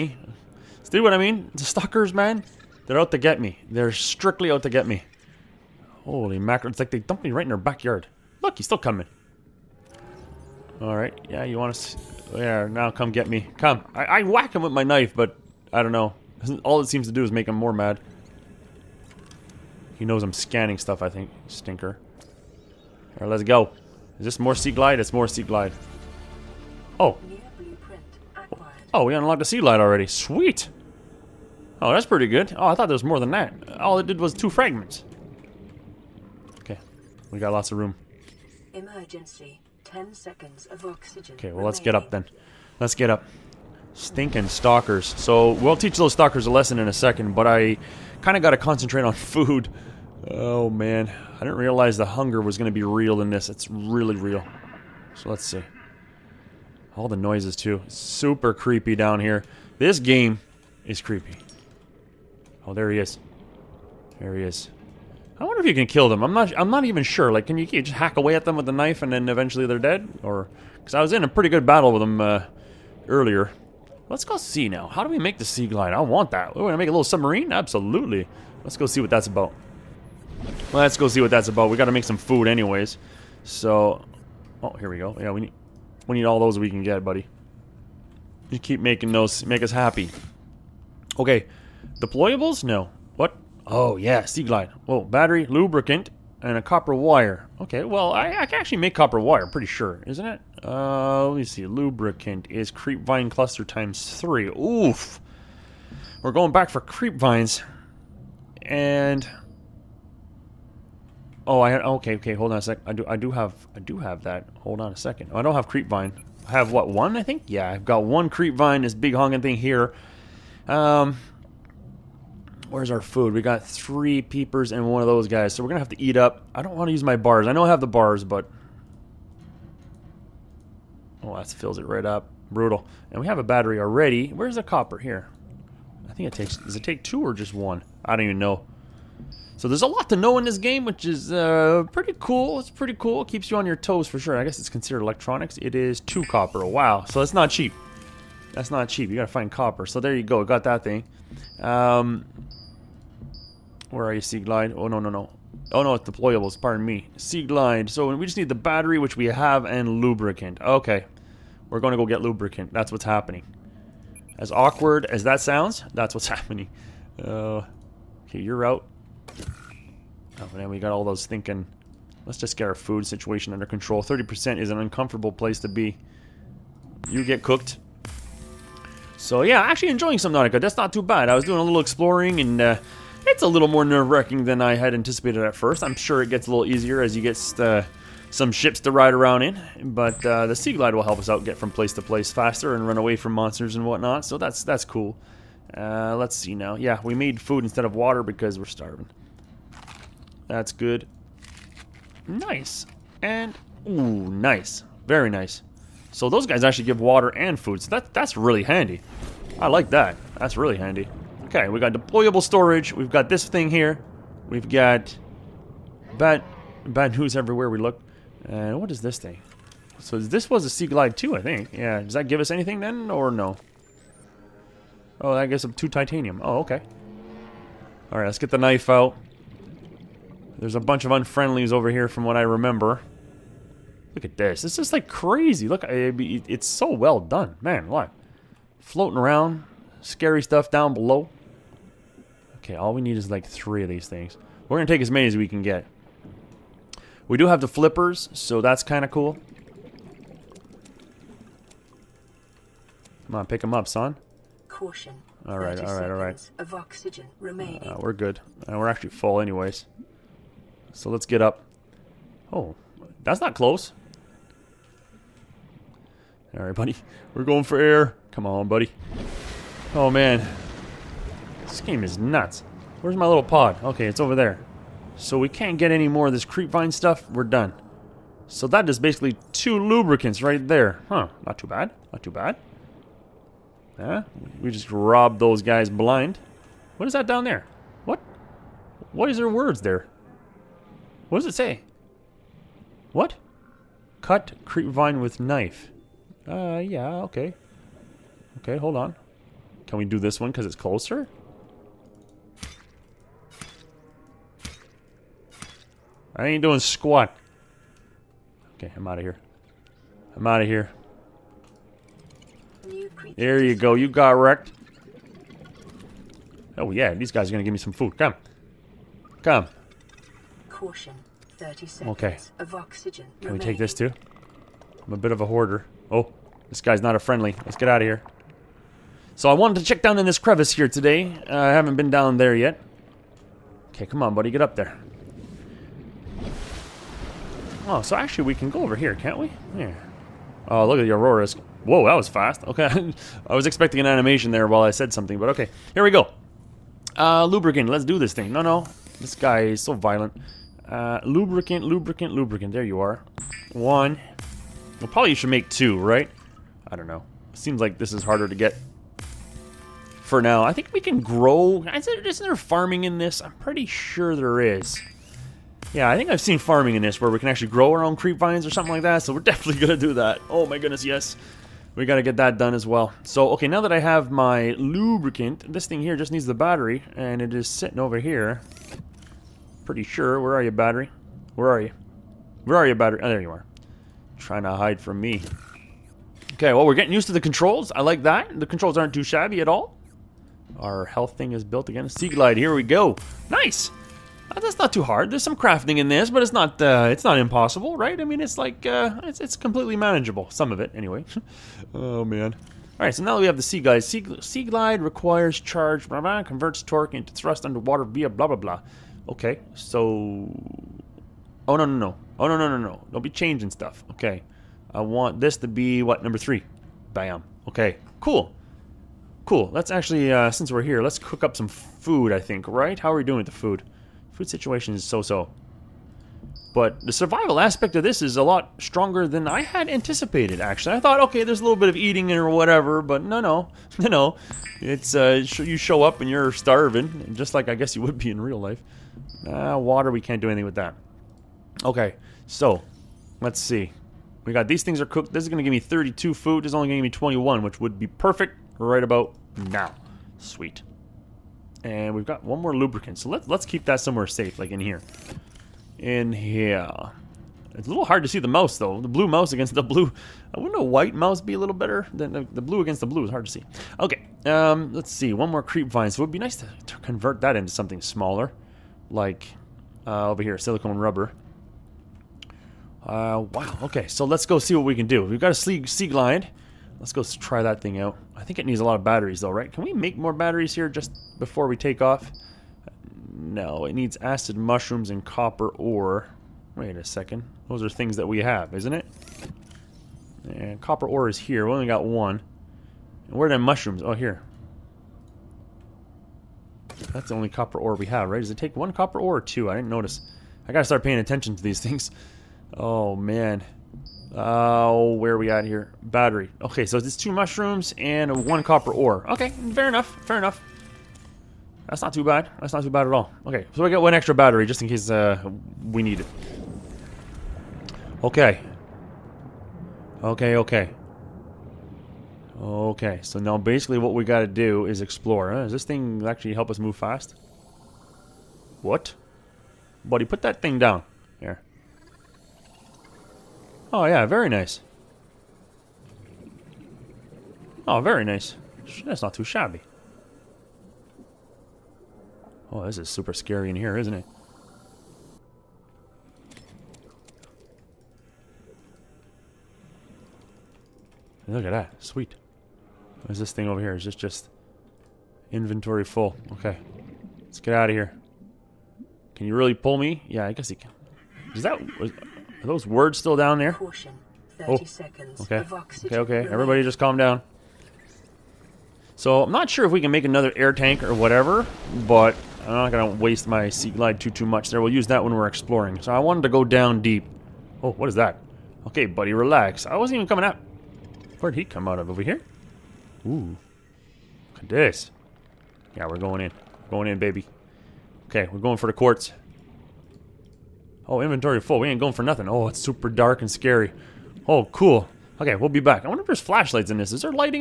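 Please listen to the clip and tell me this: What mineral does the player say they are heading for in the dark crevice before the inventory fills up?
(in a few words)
quartz.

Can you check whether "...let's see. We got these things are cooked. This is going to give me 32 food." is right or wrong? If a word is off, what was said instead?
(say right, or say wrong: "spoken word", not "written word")
right.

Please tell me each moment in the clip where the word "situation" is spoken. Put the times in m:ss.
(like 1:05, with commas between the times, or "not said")
2:53, 7:04.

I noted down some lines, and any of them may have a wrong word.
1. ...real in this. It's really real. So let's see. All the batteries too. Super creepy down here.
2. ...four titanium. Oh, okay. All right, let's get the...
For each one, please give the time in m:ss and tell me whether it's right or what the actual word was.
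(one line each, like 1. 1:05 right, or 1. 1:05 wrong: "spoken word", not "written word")
1. 0:52 wrong: "noises", not "batteries"
2. 3:45 wrong: "two", not "four".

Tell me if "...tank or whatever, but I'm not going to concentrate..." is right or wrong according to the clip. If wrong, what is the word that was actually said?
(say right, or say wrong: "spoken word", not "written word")
wrong: "waste", not "concentrate".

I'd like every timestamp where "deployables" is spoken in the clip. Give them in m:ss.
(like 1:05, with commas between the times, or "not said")
1:31, 2:36, 3:31.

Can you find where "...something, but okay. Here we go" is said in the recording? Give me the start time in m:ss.
5:45.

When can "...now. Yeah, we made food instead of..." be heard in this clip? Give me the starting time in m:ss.
3:16.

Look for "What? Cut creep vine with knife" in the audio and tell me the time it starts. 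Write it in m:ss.
4:53.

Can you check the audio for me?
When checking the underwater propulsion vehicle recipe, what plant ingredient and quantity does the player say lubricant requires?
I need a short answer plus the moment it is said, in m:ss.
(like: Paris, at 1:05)
creep vine cluster times 3, at 1:42.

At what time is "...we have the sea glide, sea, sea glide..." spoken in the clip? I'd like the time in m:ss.
6:43.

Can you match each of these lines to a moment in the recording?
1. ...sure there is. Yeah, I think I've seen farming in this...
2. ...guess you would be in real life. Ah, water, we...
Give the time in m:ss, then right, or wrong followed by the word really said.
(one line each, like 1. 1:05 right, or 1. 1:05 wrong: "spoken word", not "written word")
1. 6:03 right
2. 7:17 right.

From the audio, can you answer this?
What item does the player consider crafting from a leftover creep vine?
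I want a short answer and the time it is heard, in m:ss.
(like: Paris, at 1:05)
silicone rubber, at 7:50.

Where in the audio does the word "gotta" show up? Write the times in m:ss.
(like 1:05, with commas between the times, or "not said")
2:29, 6:12, 8:20, 8:44.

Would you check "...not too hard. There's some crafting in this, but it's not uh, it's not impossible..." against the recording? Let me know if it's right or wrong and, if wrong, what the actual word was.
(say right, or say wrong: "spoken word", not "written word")
right.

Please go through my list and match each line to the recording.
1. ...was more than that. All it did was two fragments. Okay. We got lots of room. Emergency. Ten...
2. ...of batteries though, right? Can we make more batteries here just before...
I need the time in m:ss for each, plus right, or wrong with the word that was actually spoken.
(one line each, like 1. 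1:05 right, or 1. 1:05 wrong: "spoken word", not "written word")
1. 0:32 right
2. 7:58 right.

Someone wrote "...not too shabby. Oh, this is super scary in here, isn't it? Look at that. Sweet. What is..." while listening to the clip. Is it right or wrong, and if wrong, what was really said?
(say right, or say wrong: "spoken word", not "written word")
right.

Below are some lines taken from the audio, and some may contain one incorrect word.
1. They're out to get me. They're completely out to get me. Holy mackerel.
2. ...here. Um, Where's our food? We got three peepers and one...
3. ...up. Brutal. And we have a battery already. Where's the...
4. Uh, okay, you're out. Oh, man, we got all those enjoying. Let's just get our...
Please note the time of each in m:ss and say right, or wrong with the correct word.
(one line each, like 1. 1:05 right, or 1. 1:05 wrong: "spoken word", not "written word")
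1. 0:02 wrong: "strictly", not "completely"
2. 1:59 right
3. 2:12 right
4. 2:47 wrong: "thinking", not "enjoying".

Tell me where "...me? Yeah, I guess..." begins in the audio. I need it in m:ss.
9:19.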